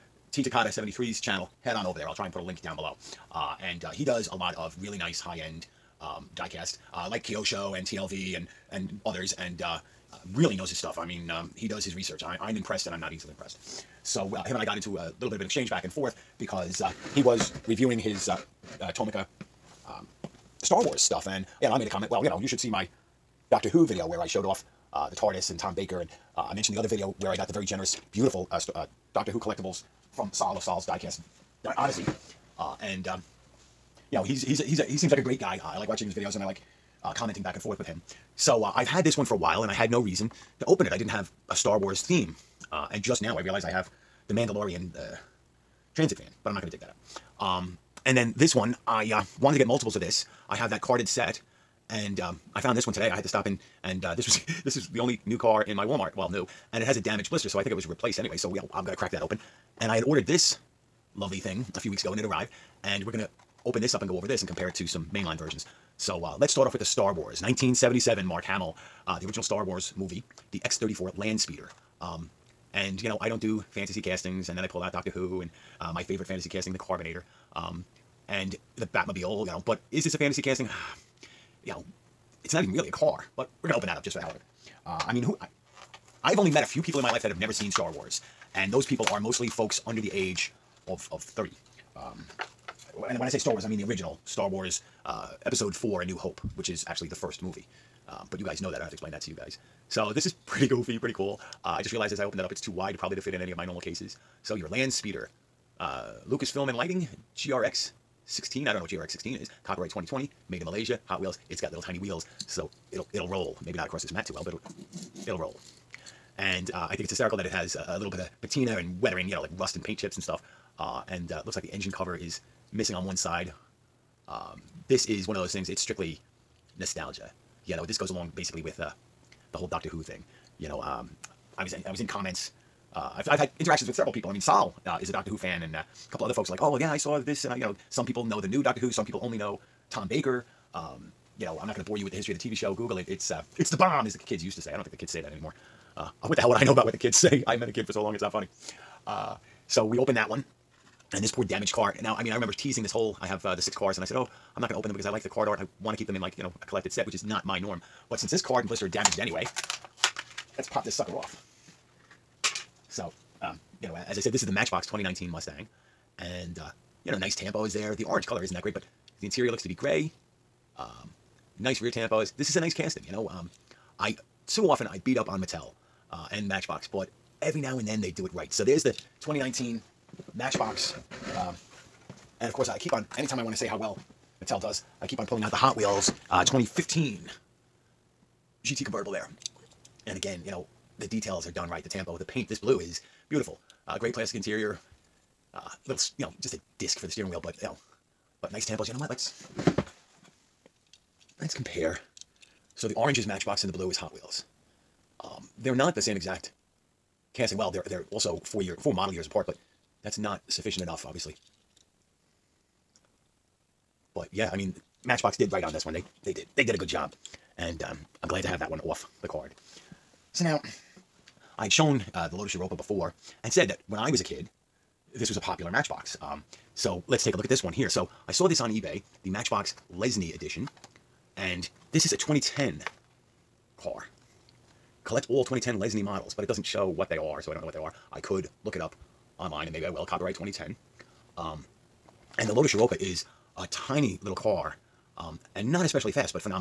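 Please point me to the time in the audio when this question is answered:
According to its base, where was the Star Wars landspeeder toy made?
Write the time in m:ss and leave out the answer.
1:50.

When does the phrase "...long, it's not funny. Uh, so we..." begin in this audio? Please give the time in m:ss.
2:28.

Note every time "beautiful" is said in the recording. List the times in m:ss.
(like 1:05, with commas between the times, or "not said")
0:28, 3:13.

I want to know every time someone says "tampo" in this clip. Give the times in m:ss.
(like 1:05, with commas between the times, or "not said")
2:47, 2:51, 3:11, 3:18.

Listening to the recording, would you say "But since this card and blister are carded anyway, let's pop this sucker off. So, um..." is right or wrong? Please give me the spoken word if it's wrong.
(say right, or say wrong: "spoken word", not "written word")
wrong: "damaged", not "carded".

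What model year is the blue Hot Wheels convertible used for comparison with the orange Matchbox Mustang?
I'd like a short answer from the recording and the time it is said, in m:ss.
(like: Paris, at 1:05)
2015, at 3:06.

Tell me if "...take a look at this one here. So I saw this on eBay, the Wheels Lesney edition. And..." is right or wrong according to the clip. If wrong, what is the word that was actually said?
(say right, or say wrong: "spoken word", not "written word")
wrong: "Matchbox", not "Wheels".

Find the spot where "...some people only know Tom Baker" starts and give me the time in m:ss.
2:18.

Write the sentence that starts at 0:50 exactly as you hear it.
I have that carded set, and um, I found this one today.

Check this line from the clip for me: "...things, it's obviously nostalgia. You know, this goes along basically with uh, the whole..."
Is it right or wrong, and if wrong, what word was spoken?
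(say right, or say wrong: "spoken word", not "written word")
wrong: "strictly", not "obviously".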